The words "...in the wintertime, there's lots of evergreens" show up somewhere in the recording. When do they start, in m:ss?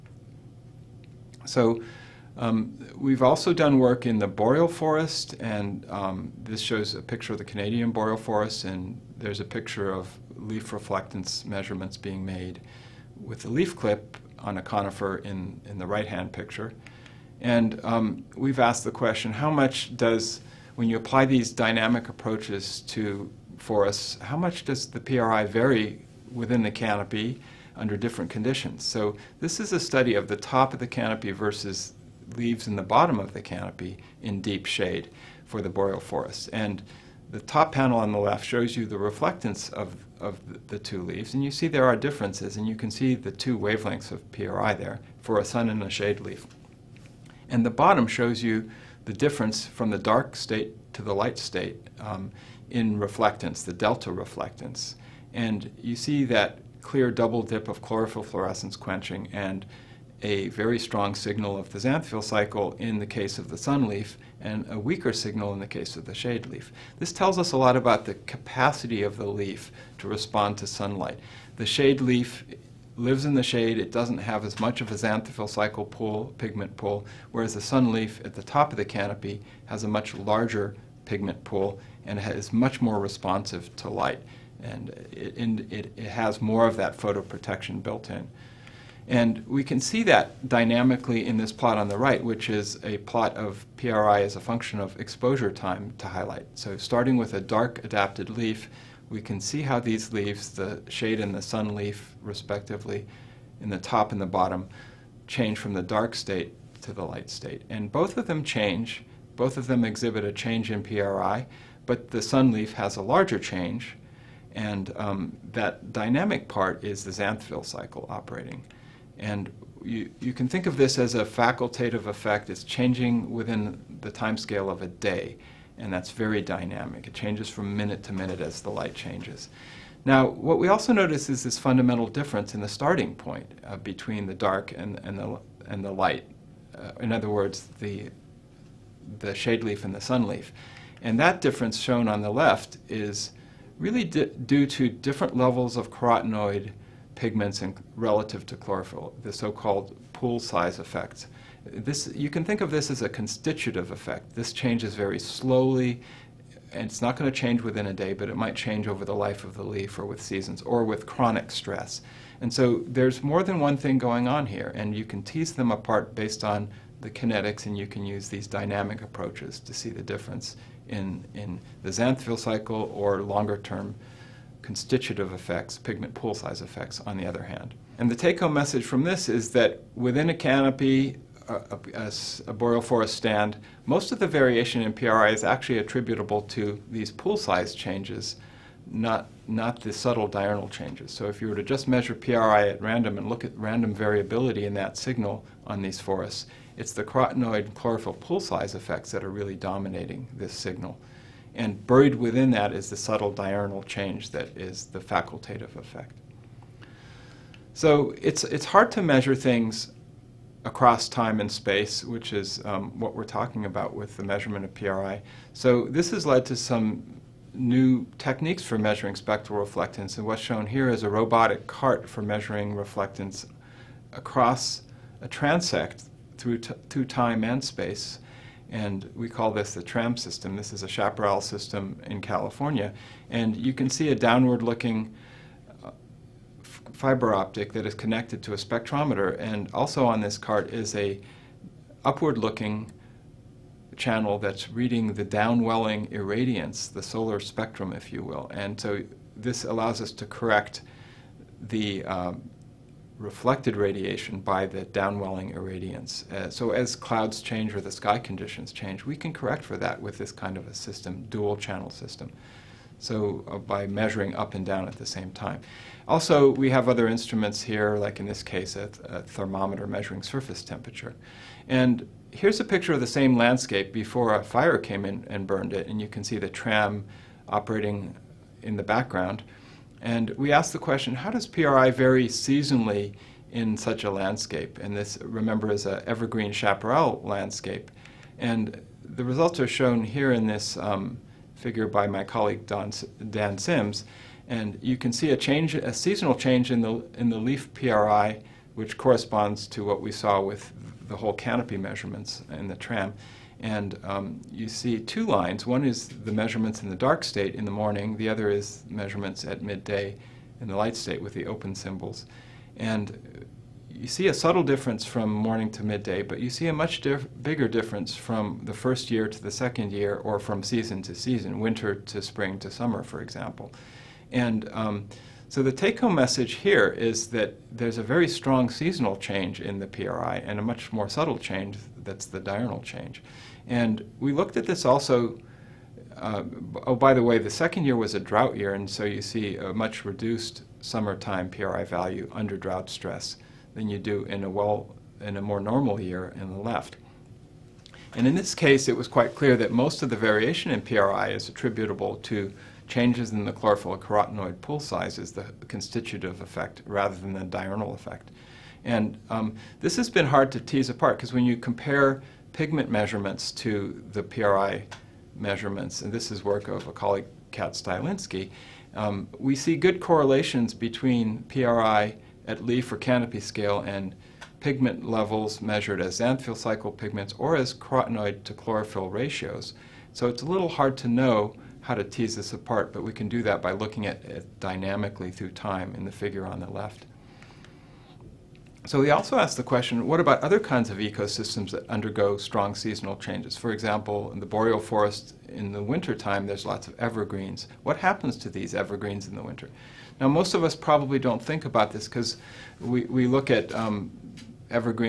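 6:35.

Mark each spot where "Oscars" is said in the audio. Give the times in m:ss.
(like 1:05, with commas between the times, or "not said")
not said.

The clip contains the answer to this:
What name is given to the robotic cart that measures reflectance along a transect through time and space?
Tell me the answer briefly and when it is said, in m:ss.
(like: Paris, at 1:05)
Tram system, at 3:49.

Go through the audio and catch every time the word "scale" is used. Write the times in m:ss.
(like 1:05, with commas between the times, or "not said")
2:04, 6:13.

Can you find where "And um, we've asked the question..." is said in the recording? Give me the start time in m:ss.
0:17.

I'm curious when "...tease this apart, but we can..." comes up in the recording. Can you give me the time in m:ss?
6:22.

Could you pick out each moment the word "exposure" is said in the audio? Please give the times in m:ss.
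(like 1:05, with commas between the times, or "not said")
1:34.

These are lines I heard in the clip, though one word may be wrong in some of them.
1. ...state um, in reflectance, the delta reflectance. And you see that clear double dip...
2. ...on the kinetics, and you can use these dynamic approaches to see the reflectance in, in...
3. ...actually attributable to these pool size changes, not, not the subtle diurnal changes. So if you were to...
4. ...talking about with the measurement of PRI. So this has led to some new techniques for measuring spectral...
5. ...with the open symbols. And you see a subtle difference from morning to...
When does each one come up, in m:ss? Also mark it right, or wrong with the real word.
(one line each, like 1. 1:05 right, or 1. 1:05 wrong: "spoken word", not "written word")
1. 0:51 right
2. 2:46 wrong: "difference", not "reflectance"
3. 3:05 right
4. 3:33 right
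5. 5:11 right.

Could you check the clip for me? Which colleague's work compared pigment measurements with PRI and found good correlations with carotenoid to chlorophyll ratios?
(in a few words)
Kat Stylinski.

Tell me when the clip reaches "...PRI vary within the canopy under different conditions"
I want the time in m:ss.
0:24.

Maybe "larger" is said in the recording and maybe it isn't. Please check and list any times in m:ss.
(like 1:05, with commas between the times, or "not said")
1:20, 1:53.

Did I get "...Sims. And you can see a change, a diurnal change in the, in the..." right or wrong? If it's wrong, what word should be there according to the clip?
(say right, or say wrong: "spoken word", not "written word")
wrong: "seasonal", not "diurnal".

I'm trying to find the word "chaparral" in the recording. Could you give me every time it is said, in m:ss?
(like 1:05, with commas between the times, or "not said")
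3:50, 4:46.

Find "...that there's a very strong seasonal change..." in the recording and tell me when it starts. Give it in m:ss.
5:27.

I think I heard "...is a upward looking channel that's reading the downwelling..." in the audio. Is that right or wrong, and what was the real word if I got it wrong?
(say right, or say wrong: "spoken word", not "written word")
right.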